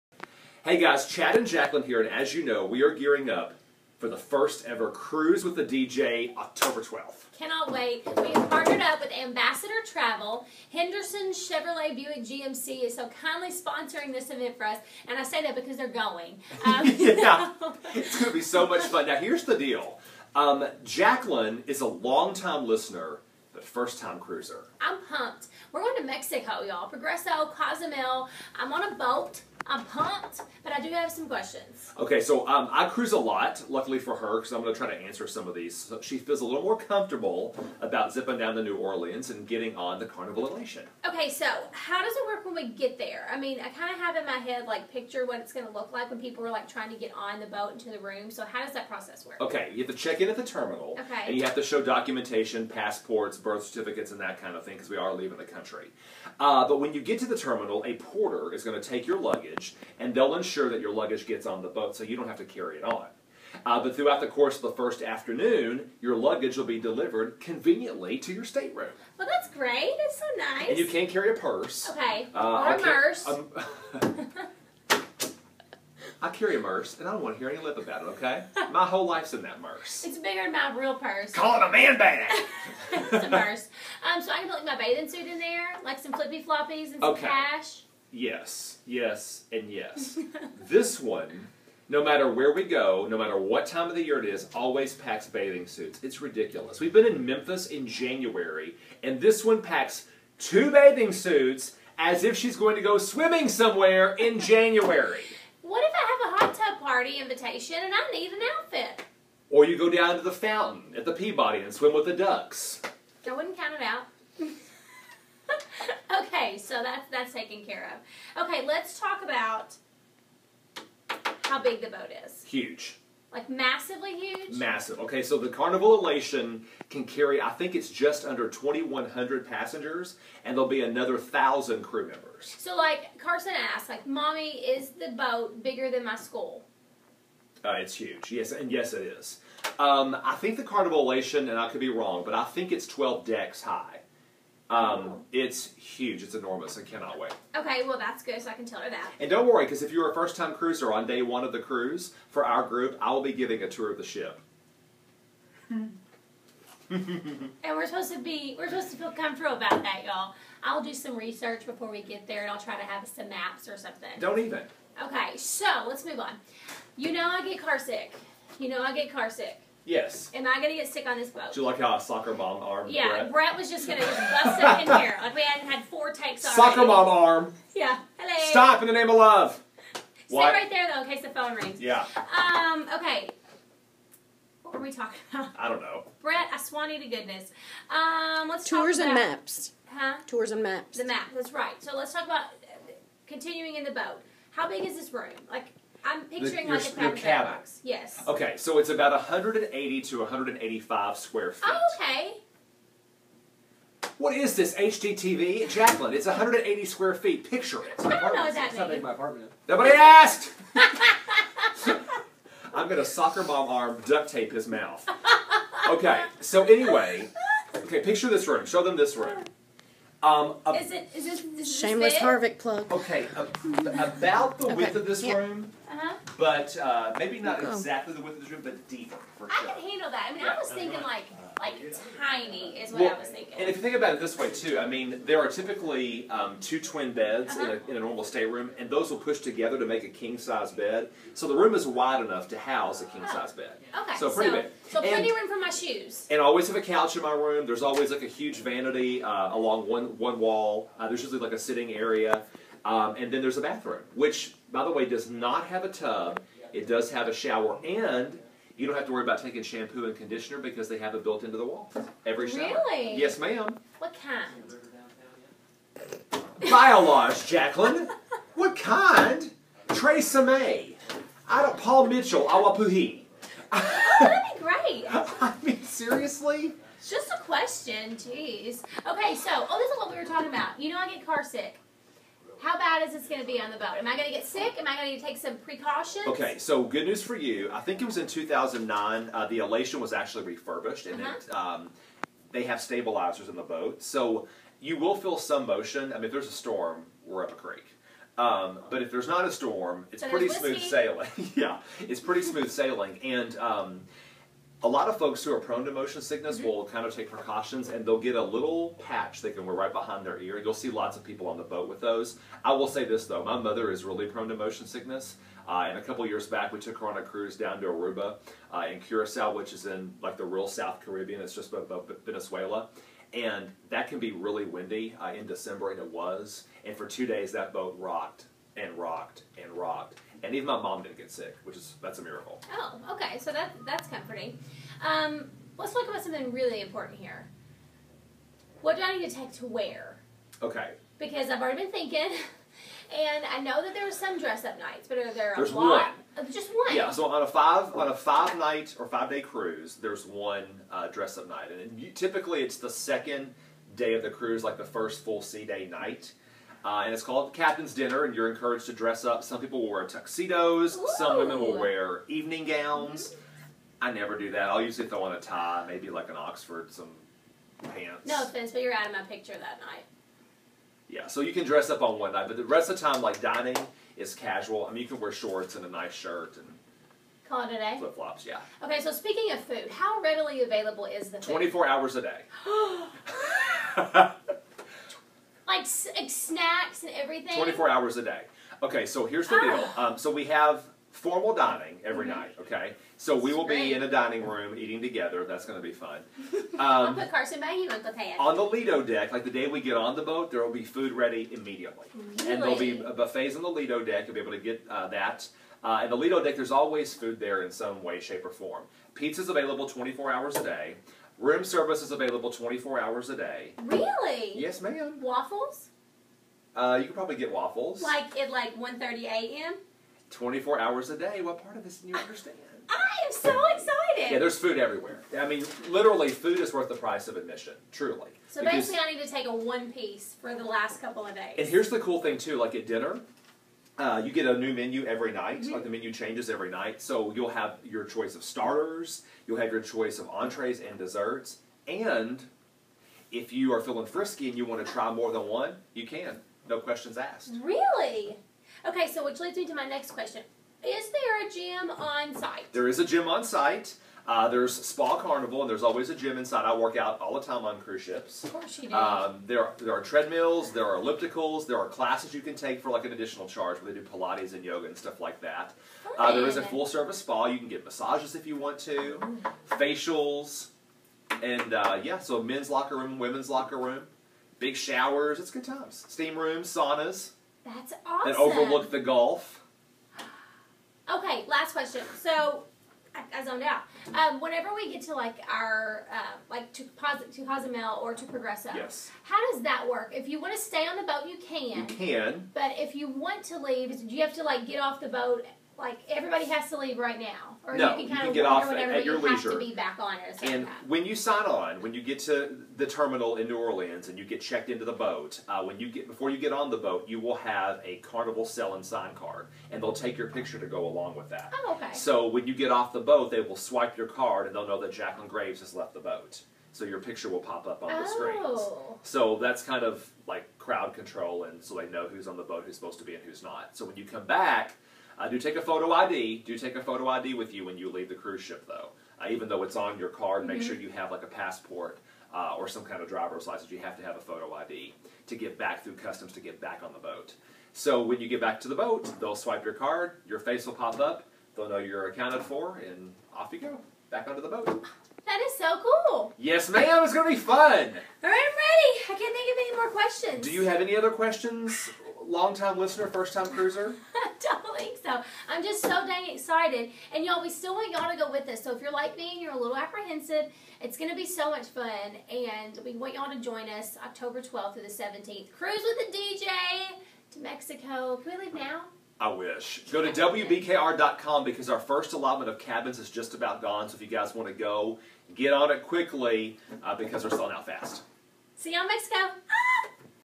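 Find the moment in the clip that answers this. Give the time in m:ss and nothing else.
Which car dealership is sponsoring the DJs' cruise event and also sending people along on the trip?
0:10.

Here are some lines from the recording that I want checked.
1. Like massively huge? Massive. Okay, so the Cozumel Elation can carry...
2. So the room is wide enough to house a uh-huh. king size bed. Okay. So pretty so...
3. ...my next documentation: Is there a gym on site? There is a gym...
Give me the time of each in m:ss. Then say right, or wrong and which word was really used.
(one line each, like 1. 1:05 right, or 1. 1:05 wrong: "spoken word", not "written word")
1. 2:03 wrong: "Carnival", not "Cozumel"
2. 4:01 right
3. 7:29 wrong: "question", not "documentation".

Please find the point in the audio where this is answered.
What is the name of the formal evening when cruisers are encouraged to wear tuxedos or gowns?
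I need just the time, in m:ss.
5:57.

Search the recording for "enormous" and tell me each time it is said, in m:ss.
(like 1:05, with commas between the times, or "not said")
2:26.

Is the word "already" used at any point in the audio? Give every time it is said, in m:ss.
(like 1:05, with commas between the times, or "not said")
2:56, 5:41.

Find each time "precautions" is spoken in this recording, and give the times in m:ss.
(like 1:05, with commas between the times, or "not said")
4:45, 5:07.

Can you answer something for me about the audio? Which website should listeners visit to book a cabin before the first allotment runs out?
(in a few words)
WBKR.com.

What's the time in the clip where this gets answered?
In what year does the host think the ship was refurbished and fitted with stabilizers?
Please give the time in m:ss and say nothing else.
4:48.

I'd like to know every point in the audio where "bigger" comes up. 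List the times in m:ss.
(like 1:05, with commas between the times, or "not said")
1:20, 2:15.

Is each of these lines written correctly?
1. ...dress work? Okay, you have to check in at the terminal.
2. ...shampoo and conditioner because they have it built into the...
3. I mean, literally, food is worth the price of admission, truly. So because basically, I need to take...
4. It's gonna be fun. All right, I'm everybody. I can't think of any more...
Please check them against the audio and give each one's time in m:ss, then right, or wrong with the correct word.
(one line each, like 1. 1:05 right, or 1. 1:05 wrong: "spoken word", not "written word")
1. 0:48 wrong: "process", not "dress"
2. 4:19 right
3. 7:05 right
4. 9:07 wrong: "ready", not "everybody".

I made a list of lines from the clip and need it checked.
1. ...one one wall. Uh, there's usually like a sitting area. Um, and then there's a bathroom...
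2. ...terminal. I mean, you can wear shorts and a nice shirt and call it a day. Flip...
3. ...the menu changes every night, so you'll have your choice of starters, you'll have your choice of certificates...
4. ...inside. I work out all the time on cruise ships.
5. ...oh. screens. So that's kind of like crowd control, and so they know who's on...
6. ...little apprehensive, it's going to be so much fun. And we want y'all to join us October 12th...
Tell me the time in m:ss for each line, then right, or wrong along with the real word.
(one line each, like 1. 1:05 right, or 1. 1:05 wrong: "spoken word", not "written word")
1. 4:09 right
2. 6:14 wrong: "casual", not "terminal"
3. 7:15 wrong: "entrees", not "certificates"
4. 7:36 right
5. 8:38 right
6. 9:19 right.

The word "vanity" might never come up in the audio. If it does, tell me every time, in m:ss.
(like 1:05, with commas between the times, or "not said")
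4:08.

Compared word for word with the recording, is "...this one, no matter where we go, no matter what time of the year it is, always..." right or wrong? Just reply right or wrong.
right.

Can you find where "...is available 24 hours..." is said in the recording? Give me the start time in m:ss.
6:52.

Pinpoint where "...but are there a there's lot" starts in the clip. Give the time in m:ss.
5:45.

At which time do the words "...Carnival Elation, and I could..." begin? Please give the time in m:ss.
2:20.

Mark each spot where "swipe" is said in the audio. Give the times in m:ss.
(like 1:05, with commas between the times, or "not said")
8:33, 8:59.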